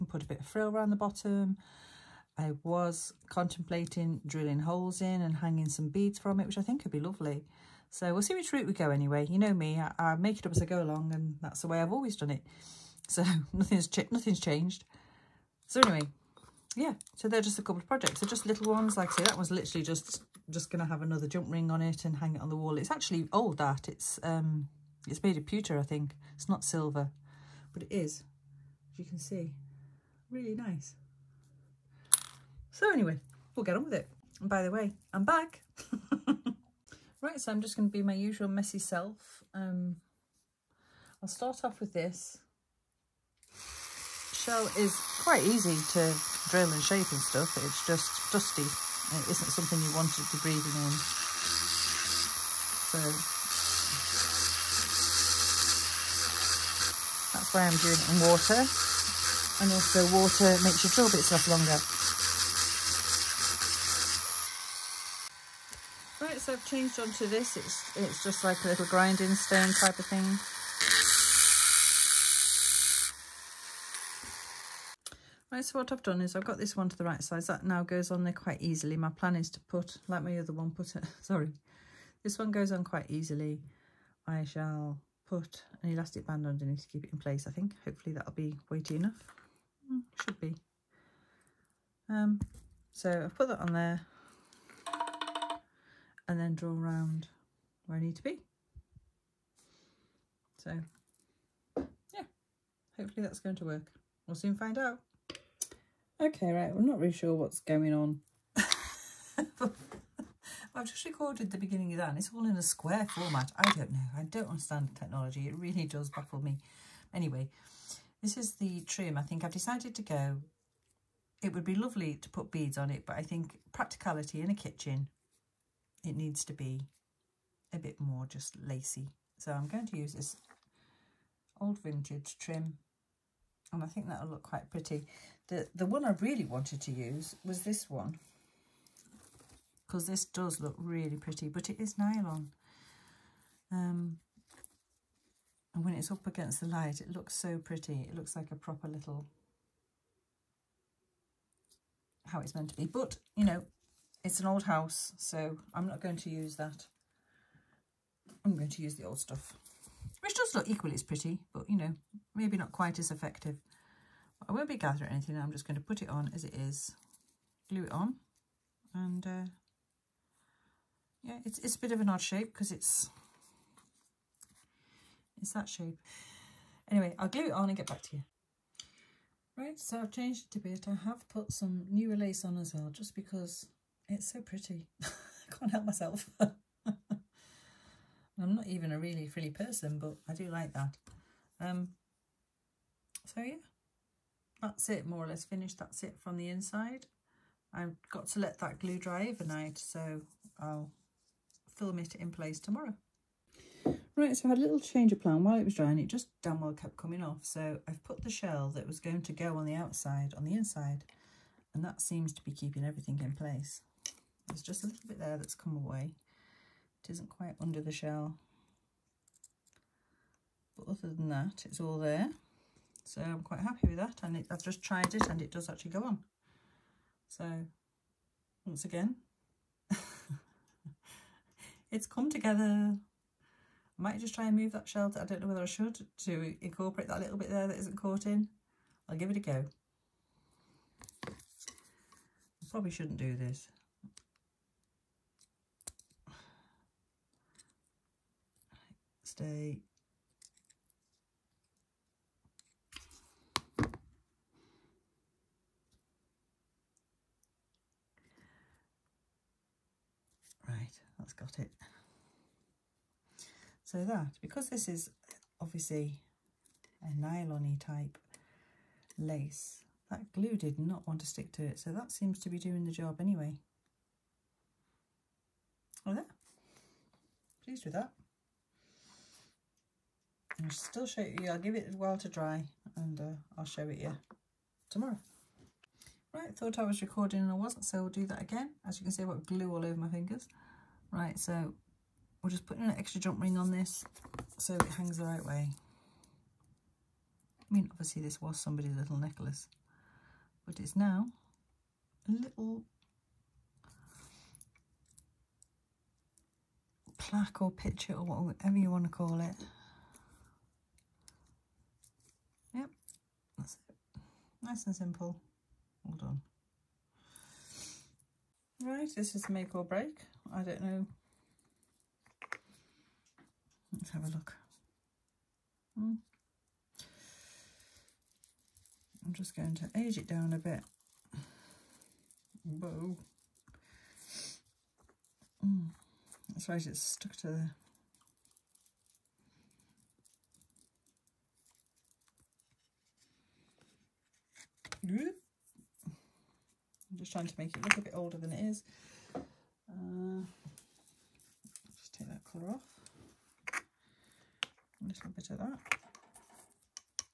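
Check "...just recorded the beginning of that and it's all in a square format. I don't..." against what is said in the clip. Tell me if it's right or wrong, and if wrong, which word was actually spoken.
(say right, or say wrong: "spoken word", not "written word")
right.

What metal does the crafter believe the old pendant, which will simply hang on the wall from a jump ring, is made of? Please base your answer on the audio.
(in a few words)
pewter.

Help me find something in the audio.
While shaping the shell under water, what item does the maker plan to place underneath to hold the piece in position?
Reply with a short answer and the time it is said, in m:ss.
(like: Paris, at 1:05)
an elastic band, at 1:25.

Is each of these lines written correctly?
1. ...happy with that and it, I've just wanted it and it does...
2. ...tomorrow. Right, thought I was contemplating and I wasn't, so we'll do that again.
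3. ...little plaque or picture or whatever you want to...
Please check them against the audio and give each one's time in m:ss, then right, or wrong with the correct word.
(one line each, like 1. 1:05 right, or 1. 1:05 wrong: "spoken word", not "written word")
1. 3:43 wrong: "tried", not "wanted"
2. 4:44 wrong: "recording", not "contemplating"
3. 5:02 right.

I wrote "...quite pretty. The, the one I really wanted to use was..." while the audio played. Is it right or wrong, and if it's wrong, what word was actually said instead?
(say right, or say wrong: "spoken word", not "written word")
right.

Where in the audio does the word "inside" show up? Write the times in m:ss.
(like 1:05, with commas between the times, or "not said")
3:16, 3:30.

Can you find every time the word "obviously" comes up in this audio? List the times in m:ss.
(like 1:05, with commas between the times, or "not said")
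4:25, 4:57.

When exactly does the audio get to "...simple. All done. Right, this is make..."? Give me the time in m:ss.
5:14.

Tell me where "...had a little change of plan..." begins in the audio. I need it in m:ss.
3:24.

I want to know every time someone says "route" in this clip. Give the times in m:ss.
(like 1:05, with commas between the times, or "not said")
0:08.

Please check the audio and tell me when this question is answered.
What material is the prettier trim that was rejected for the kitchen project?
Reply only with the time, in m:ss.
2:21.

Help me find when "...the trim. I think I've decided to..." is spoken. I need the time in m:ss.
1:58.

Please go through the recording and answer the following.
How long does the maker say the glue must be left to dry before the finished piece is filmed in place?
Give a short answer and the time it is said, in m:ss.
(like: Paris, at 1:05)
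overnight, at 3:19.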